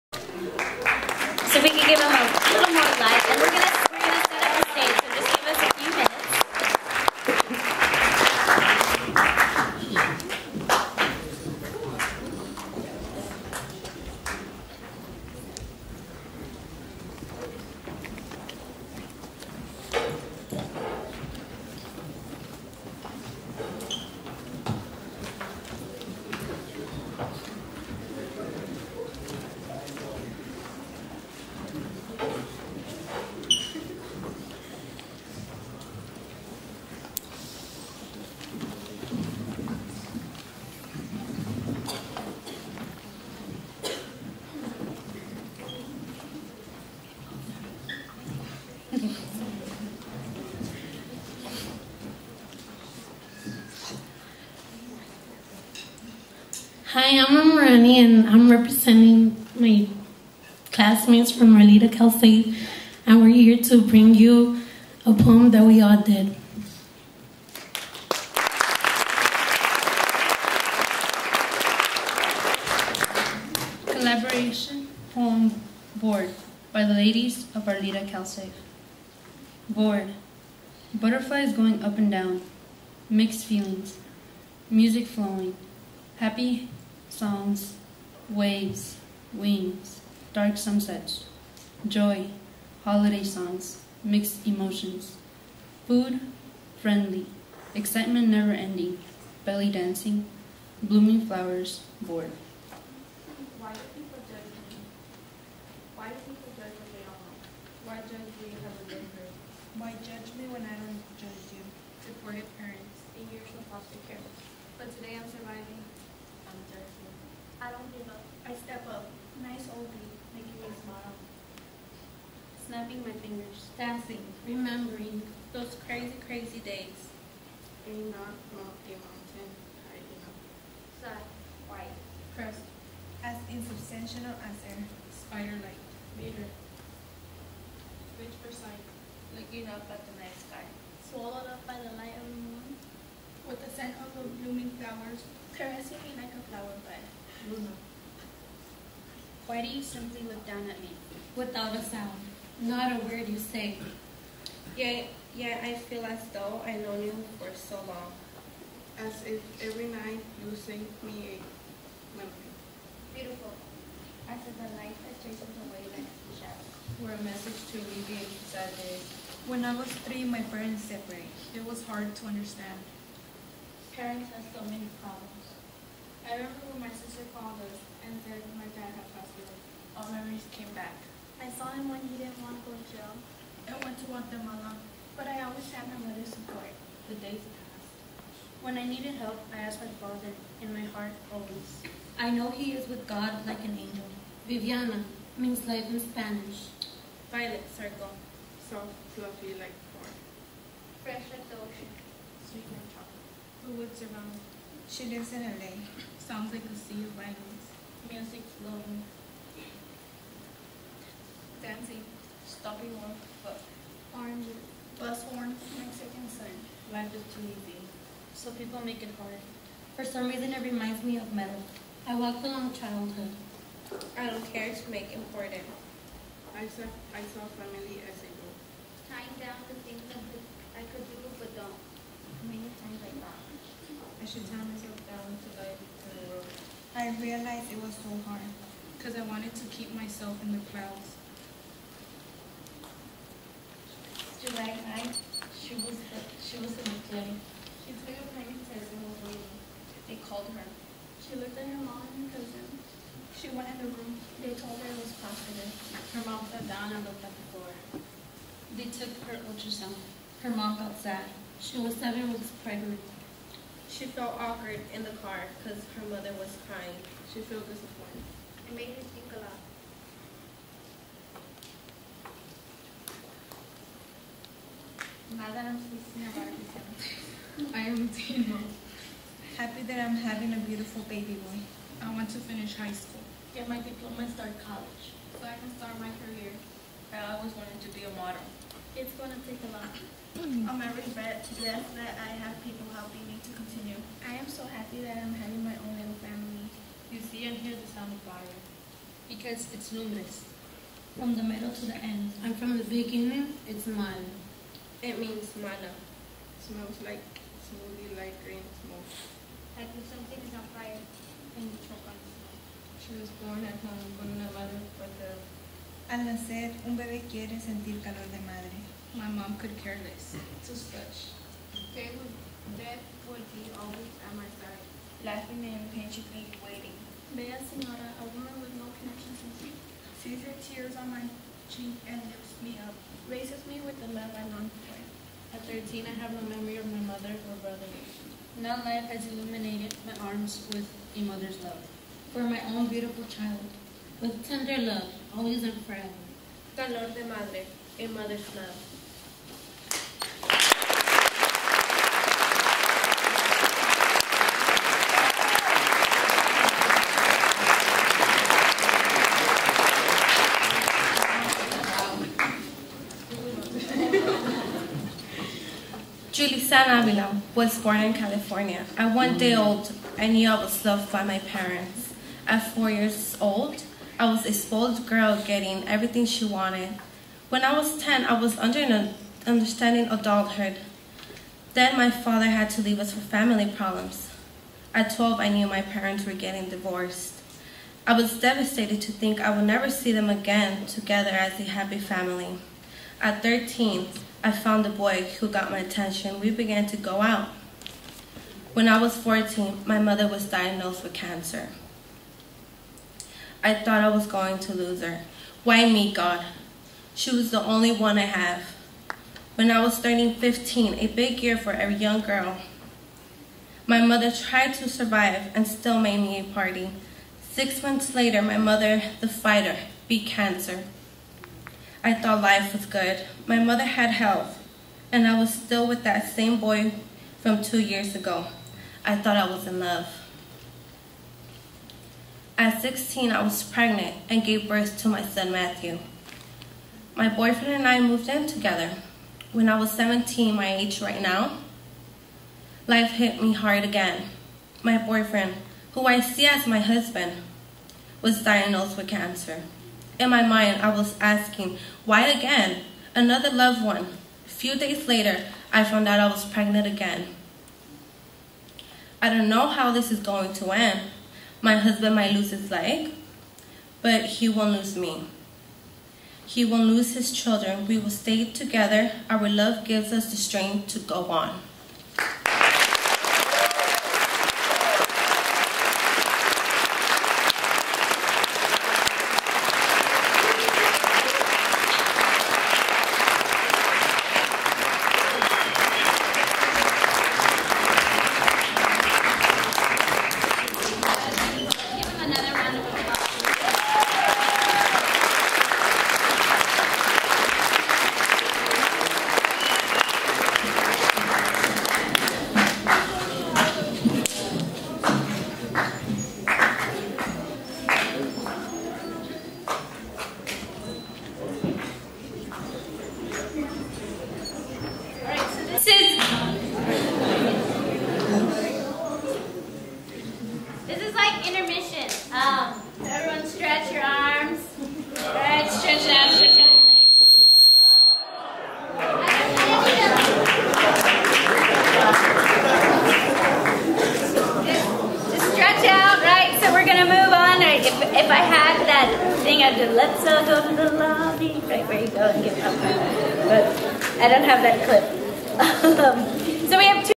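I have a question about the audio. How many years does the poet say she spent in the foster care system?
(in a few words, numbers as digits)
8.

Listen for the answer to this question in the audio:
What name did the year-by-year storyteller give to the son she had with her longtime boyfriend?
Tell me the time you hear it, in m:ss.
7:15.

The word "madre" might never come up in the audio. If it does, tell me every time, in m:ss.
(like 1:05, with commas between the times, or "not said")
5:18, 5:47.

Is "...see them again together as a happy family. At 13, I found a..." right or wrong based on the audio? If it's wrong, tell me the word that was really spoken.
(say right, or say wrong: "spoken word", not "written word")
right.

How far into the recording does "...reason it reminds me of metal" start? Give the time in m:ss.
3:40.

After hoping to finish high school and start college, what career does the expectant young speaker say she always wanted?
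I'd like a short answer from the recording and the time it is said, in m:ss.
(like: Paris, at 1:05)
Model, at 4:48.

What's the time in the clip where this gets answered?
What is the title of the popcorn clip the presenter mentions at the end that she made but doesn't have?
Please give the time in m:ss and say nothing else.
8:59.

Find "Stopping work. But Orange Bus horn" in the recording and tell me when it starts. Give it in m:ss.
3:32.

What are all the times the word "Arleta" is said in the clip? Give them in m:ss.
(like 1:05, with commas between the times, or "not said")
1:01, 1:17.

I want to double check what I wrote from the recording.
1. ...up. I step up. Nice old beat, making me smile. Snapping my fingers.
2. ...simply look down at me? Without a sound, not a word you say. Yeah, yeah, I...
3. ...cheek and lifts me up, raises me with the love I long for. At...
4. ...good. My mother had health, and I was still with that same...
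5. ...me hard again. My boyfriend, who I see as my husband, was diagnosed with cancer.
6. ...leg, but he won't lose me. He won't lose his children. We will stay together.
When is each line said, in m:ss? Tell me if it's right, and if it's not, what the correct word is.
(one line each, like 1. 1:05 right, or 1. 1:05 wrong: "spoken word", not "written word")
1. 1:58 right
2. 2:29 right
3. 5:31 right
4. 7:02 right
5. 7:23 right
6. 7:42 right.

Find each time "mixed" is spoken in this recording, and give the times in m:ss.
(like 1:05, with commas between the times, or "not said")
1:23, 1:34.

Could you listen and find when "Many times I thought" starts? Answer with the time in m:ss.
3:52.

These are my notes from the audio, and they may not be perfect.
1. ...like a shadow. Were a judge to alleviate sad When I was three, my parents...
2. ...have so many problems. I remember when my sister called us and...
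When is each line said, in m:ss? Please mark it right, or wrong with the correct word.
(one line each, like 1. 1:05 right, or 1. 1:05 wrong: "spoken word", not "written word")
1. 2:45 wrong: "message", not "judge"
2. 2:54 right.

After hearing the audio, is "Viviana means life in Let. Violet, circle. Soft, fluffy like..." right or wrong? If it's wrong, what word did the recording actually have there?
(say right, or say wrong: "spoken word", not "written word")
wrong: "Spanish", not "Let".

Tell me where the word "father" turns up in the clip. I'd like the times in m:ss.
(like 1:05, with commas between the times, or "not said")
3:09, 6:22.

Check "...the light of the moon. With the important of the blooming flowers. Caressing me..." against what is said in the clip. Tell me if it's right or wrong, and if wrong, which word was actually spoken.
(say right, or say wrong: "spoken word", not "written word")
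wrong: "scent", not "important".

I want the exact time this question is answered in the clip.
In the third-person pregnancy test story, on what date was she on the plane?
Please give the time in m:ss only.
4:04.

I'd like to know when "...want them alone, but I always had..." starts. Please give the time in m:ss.
3:04.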